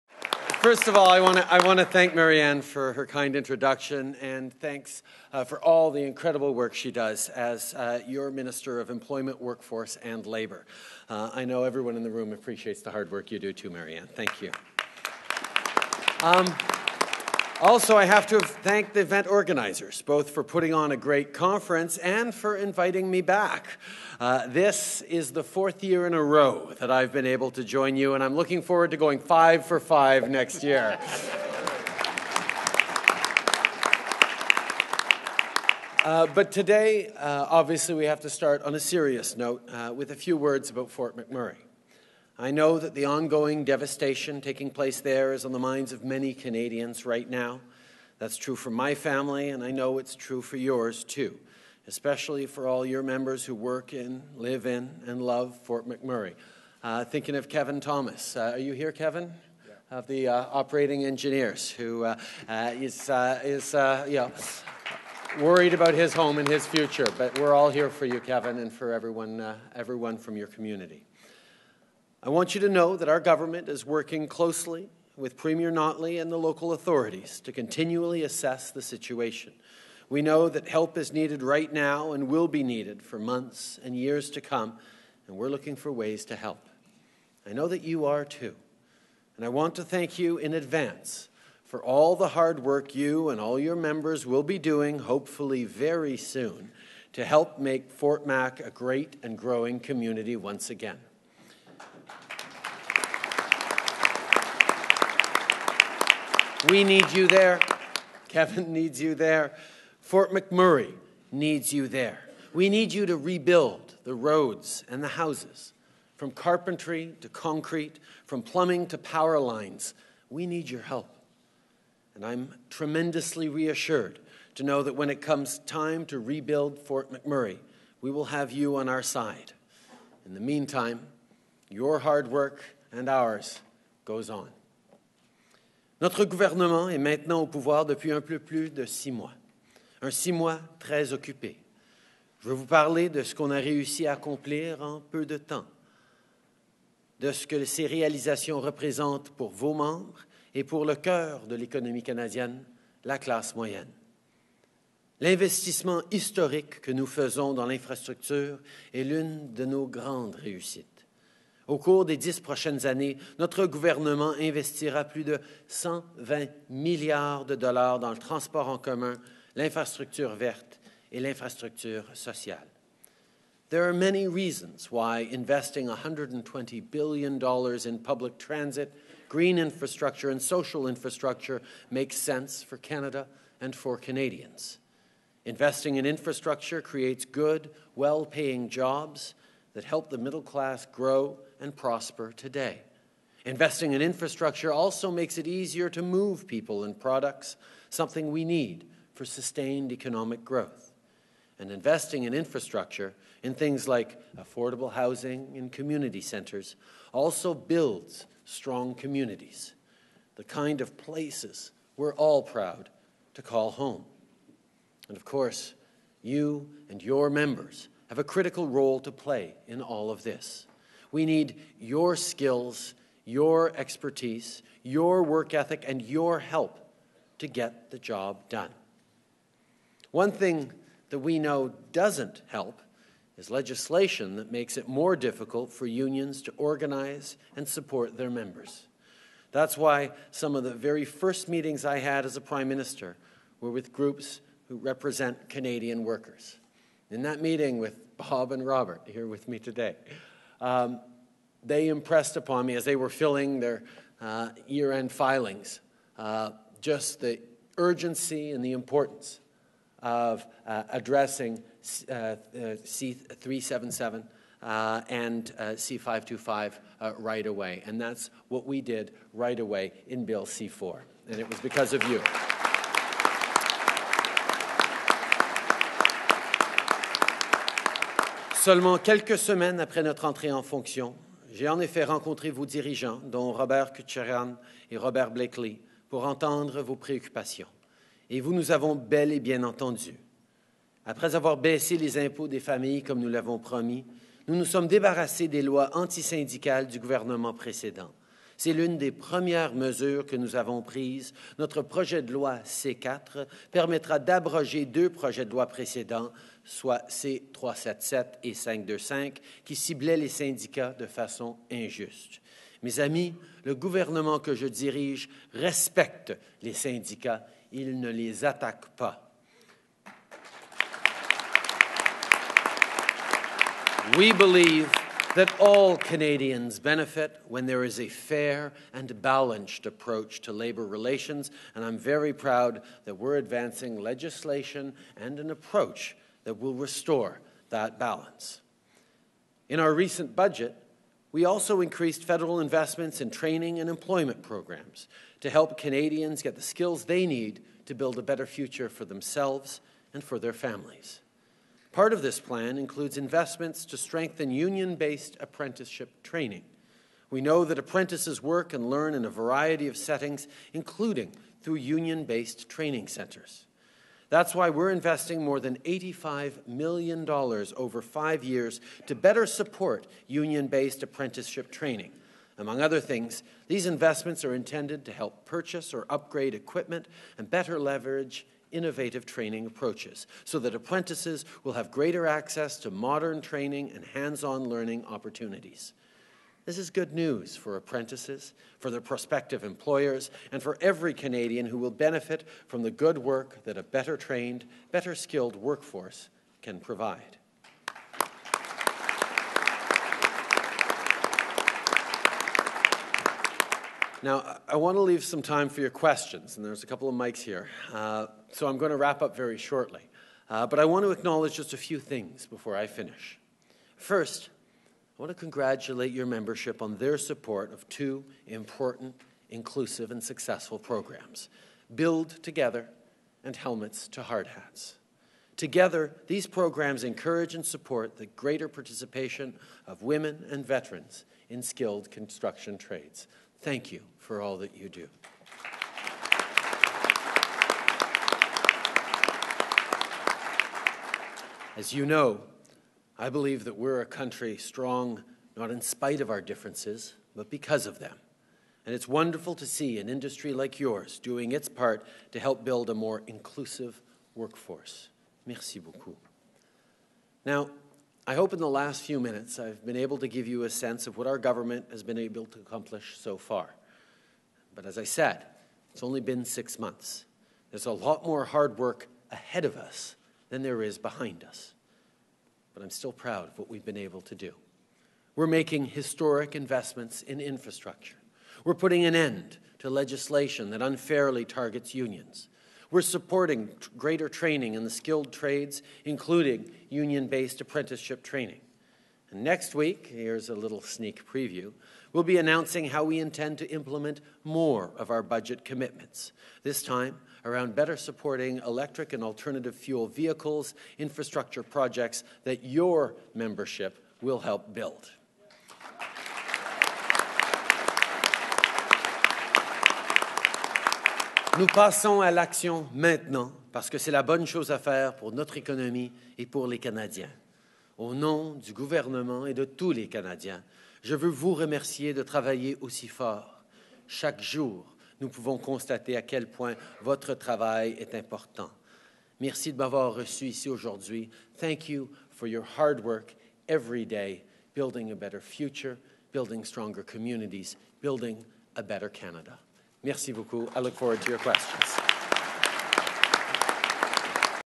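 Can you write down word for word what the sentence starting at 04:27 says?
And that's what we did right away in Bill C4.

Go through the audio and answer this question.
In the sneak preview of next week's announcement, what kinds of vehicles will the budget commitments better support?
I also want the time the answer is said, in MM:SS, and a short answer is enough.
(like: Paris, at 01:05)
electric and alternative fuel vehicles, at 08:18.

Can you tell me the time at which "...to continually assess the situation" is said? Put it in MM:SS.
01:17.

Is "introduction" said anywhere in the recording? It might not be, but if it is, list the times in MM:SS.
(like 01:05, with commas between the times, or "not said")
00:03.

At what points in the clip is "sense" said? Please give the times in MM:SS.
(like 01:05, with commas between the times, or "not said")
03:02, 07:40.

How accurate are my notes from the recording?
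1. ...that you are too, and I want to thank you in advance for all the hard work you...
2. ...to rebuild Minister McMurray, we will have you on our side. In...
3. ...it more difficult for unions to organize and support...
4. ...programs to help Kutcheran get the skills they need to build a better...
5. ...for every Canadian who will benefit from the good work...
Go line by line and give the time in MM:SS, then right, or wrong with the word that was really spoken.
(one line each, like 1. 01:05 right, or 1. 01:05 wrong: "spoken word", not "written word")
1. 01:27 right
2. 02:06 wrong: "Fort", not "Minister"
3. 03:54 right
4. 05:44 wrong: "Canadians", not "Kutcheran"
5. 06:30 right.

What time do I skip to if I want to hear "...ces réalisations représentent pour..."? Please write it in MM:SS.
02:27.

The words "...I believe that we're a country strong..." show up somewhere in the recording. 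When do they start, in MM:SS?
07:23.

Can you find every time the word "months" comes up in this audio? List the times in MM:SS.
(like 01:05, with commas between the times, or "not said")
01:23, 07:46.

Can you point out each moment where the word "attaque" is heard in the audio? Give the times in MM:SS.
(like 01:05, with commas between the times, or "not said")
05:18.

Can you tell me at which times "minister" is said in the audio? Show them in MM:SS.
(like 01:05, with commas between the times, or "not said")
00:08, 04:02.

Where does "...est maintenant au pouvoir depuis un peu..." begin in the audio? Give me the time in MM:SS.
02:16.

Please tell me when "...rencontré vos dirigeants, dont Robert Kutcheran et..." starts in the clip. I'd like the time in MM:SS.
04:42.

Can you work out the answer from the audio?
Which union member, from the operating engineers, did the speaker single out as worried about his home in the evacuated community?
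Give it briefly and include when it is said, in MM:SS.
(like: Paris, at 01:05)
Kevin Thomas, at 00:57.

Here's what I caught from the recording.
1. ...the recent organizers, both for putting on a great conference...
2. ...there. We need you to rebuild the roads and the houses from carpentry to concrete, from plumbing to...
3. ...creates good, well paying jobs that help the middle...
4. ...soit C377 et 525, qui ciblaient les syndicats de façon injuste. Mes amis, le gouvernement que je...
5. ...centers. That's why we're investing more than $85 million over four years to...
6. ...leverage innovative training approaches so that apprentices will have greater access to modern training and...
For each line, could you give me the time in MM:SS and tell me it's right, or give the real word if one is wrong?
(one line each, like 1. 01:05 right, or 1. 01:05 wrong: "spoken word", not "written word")
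1. 00:18 wrong: "event", not "recent"
2. 01:51 right
3. 03:06 right
4. 05:06 right
5. 06:03 wrong: "five", not "four"
6. 06:17 right.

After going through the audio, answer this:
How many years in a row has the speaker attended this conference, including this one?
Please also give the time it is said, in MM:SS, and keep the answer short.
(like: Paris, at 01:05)
4, at 00:25.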